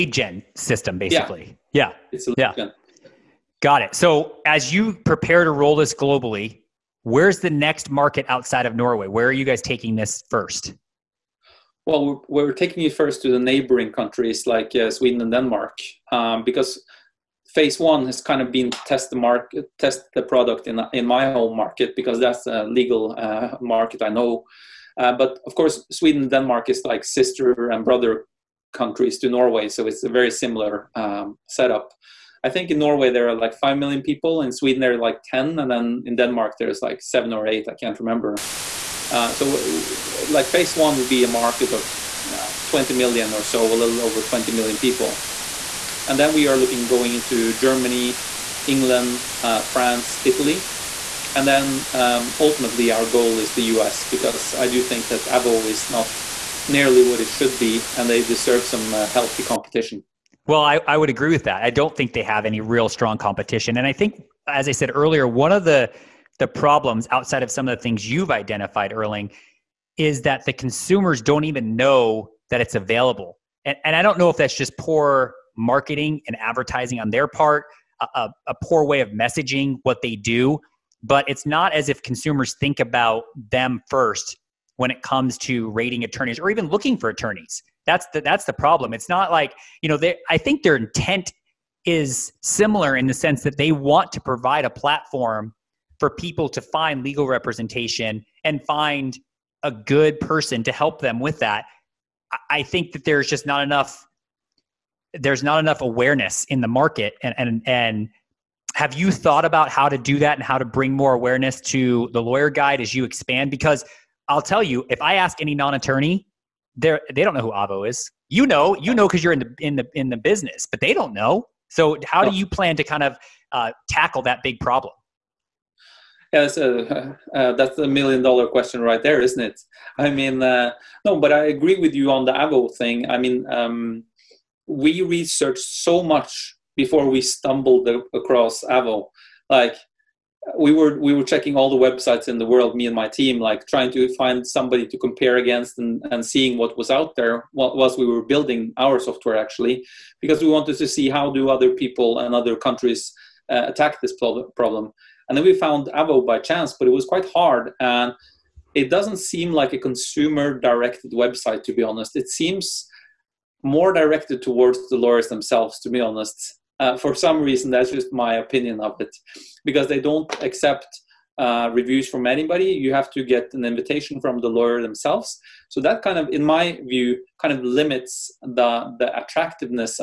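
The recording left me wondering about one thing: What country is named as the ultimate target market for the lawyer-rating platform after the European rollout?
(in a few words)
U.S.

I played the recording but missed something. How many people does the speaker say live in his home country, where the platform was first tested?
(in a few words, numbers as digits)
5 million.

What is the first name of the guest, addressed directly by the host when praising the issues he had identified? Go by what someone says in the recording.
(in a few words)
Erling.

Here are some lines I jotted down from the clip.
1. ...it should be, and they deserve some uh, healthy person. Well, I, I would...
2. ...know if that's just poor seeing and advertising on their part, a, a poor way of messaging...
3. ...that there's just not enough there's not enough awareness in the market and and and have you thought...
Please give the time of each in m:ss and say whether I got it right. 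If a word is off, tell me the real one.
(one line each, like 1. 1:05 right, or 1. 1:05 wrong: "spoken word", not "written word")
1. 0:57 wrong: "competition", not "person"
2. 1:14 wrong: "marketing", not "seeing"
3. 1:42 right.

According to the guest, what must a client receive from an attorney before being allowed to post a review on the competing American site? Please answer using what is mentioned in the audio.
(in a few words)
An invitation.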